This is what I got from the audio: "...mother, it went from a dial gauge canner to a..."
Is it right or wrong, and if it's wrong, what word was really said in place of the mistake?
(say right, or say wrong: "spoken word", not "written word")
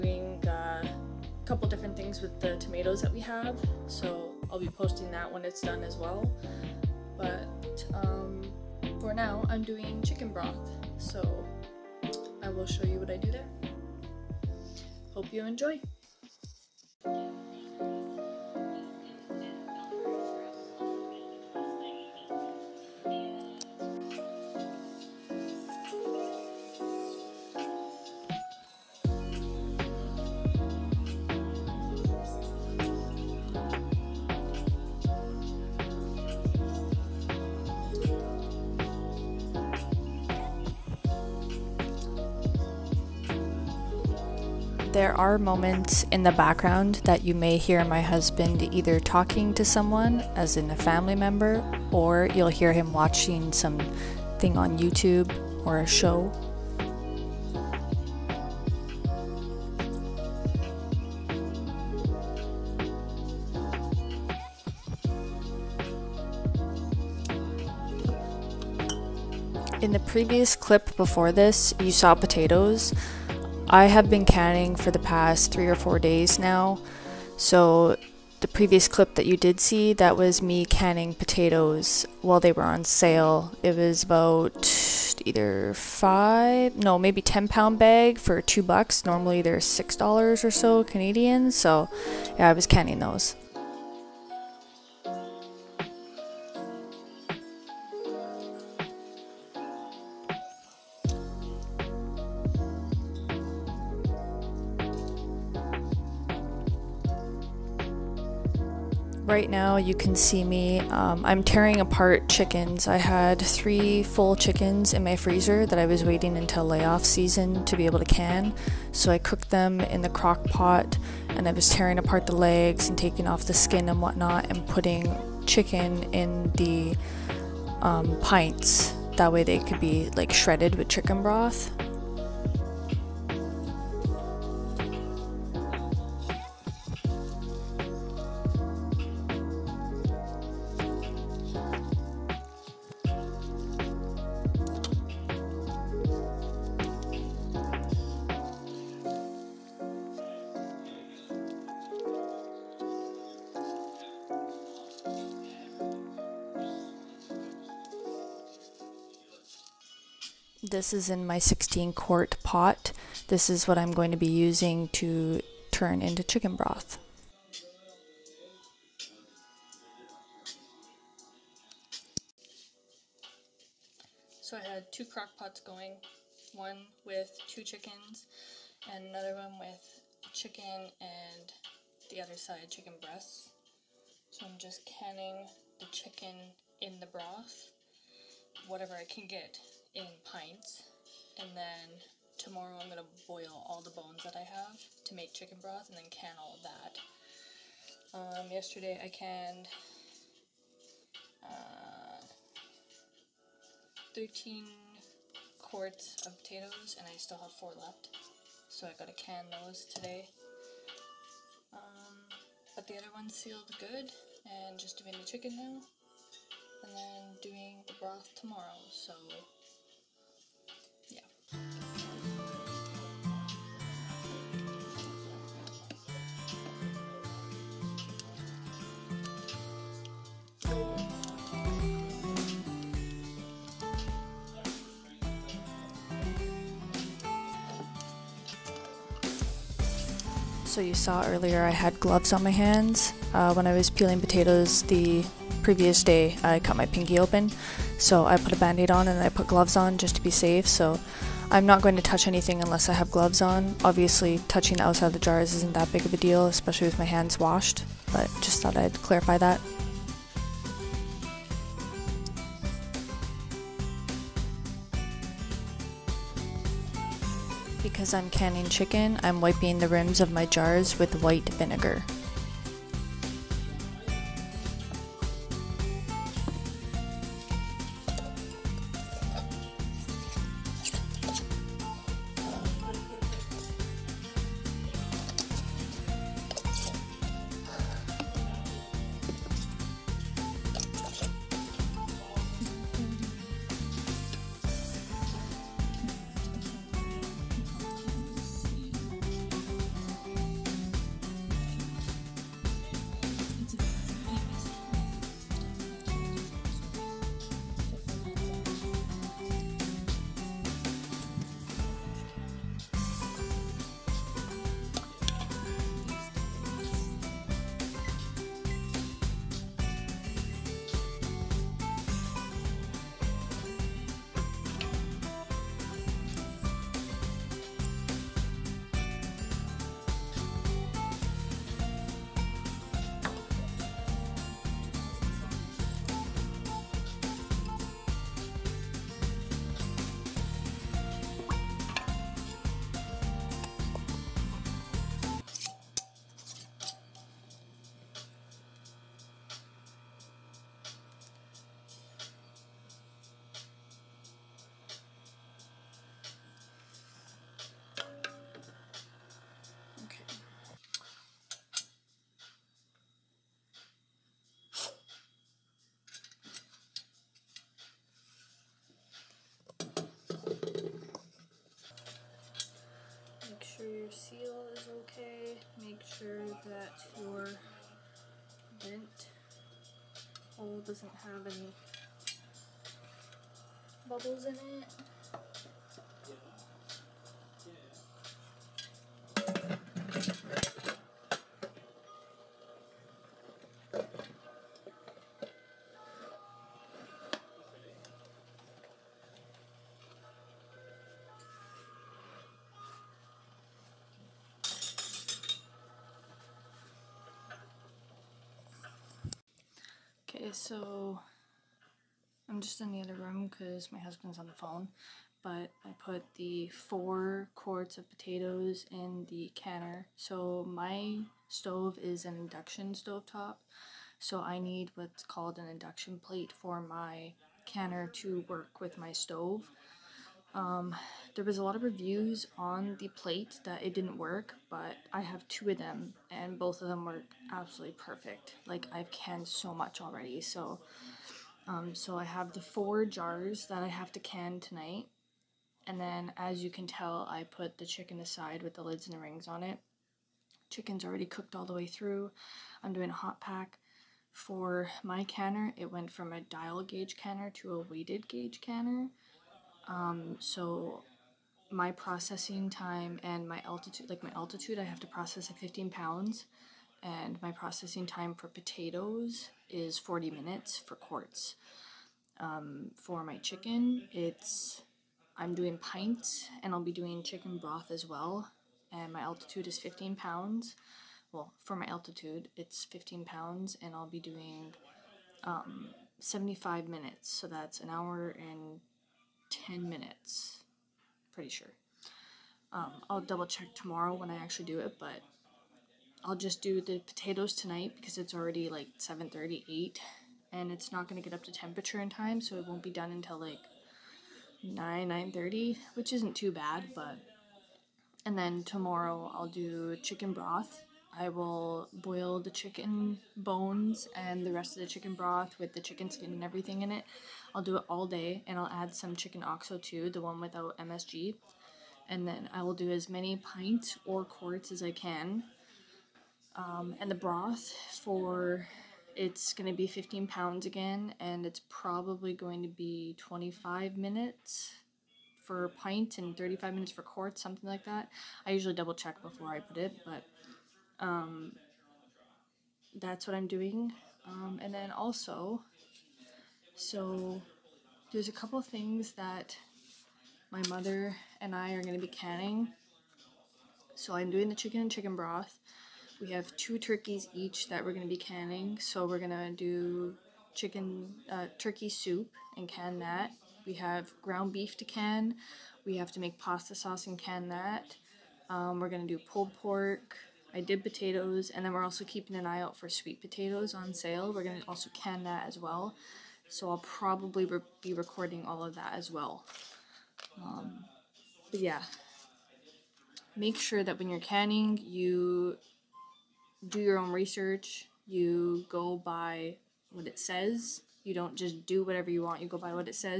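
wrong: "canner", not "mother".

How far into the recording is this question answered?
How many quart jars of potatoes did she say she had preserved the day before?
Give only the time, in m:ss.
3:24.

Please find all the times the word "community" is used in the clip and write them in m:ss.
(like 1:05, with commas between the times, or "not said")
not said.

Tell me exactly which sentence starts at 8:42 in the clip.
And then I will do as many pints or quarts as I can.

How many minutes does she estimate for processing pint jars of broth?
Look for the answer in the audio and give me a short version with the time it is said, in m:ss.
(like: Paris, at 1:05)
25 minutes, at 8:53.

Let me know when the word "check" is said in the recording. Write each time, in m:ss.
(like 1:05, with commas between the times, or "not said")
8:13, 8:58.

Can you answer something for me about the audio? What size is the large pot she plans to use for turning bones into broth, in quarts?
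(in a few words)
16 quart.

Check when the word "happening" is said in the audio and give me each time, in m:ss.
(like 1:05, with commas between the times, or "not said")
not said.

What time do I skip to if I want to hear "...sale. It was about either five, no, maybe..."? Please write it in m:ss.
1:22.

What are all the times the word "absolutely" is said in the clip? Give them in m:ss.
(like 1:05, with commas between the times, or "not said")
7:17.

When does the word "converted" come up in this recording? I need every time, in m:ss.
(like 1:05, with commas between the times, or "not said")
not said.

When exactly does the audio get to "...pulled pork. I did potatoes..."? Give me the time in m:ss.
9:29.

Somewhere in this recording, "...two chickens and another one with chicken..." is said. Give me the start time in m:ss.
2:57.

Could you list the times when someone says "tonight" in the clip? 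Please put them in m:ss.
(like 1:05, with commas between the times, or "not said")
7:24, 8:17.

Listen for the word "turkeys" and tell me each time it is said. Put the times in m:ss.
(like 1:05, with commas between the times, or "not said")
9:16, 9:21.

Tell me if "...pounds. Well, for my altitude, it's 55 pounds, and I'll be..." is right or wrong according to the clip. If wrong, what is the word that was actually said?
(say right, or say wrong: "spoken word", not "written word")
wrong: "15", not "55".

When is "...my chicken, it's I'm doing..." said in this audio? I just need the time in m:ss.
7:53.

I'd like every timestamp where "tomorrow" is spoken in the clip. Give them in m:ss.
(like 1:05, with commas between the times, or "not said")
3:12, 3:38, 8:13, 8:28.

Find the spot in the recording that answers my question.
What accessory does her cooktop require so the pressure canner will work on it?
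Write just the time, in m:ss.
7:05.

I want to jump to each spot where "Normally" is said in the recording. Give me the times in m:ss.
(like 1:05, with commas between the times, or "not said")
1:29.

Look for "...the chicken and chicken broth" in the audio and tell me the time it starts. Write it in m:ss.
9:14.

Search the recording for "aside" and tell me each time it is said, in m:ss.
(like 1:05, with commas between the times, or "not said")
7:28.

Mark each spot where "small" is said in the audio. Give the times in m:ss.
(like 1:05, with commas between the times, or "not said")
not said.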